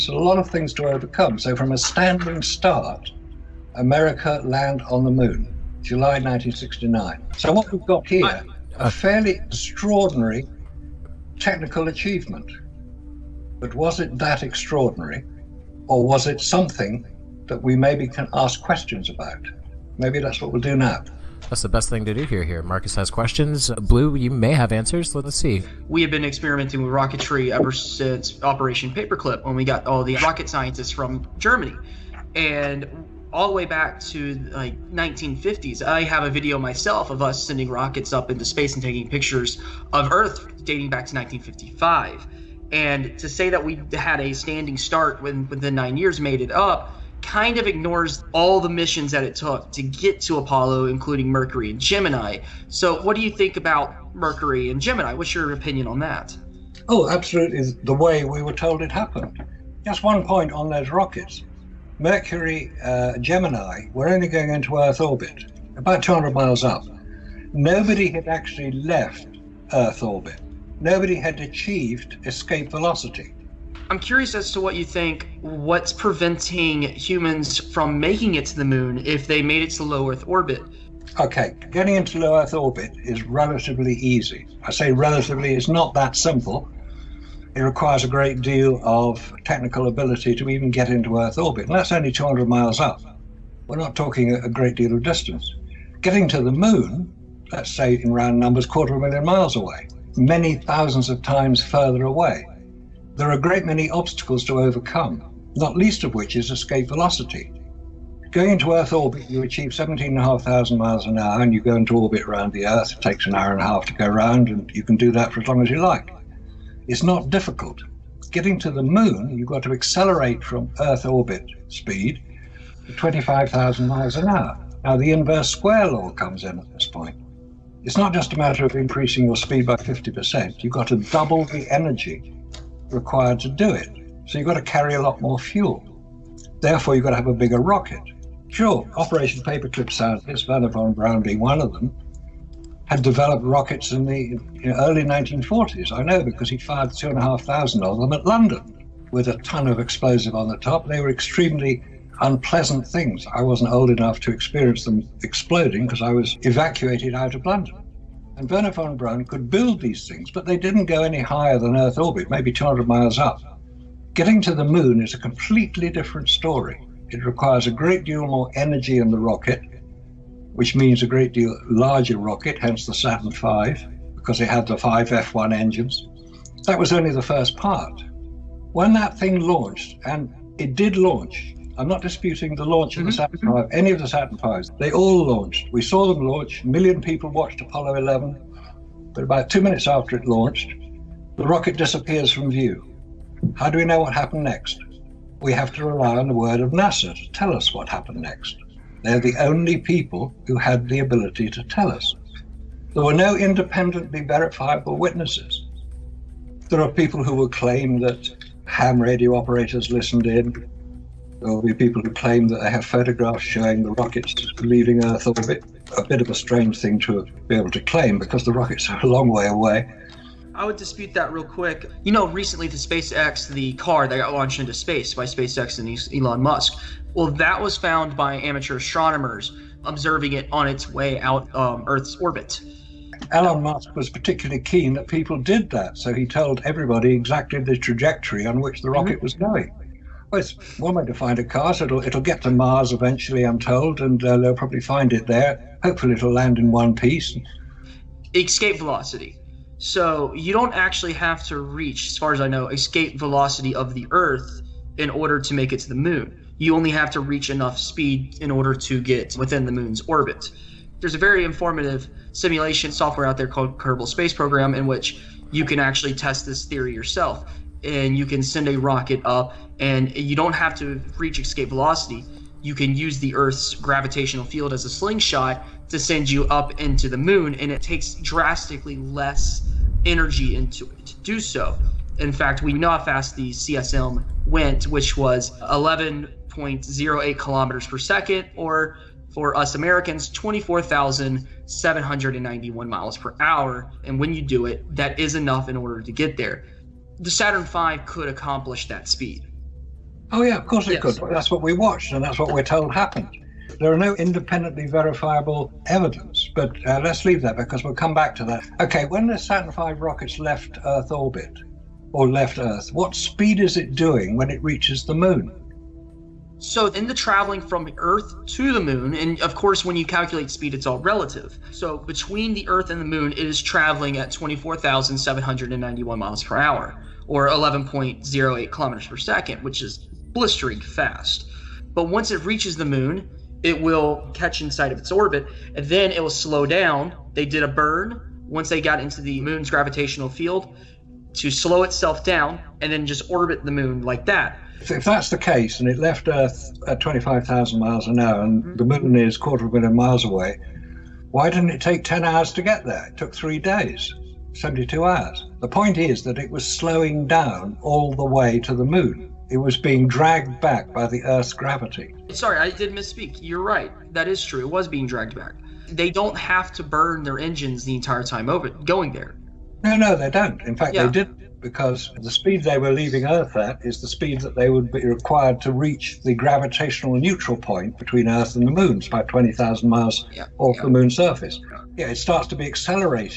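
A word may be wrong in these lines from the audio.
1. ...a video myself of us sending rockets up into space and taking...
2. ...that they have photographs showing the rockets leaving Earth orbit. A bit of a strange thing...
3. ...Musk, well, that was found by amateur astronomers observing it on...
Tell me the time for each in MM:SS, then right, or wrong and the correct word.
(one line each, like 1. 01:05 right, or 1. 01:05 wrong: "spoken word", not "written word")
1. 00:36 right
2. 03:32 right
3. 03:46 right.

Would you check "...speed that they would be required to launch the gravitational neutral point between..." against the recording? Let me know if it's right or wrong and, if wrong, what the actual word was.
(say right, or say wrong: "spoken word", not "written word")
wrong: "reach", not "launch".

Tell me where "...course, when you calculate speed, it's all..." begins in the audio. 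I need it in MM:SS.
05:19.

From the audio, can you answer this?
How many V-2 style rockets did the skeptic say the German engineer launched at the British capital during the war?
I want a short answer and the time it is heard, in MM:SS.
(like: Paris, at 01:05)
2,500, at 02:26.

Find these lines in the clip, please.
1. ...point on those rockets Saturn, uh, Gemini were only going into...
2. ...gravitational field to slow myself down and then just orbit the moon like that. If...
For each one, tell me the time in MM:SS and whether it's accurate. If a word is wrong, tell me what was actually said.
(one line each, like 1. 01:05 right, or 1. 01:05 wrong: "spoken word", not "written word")
1. 01:00 wrong: "Mercury", not "Saturn"
2. 05:39 wrong: "itself", not "myself".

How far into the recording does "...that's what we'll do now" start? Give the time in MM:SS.
00:20.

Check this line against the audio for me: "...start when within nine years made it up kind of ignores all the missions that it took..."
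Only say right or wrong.
right.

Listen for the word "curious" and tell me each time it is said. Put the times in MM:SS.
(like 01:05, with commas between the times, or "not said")
01:13.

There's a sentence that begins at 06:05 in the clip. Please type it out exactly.
They don't have to burn their engines the entire time over going there.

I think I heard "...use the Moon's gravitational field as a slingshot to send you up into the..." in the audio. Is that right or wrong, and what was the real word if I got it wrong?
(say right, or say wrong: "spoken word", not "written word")
wrong: "Earth", not "Moon".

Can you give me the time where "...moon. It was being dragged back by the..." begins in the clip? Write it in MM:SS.
05:58.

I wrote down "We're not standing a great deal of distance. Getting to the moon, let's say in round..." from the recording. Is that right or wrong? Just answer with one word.
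wrong.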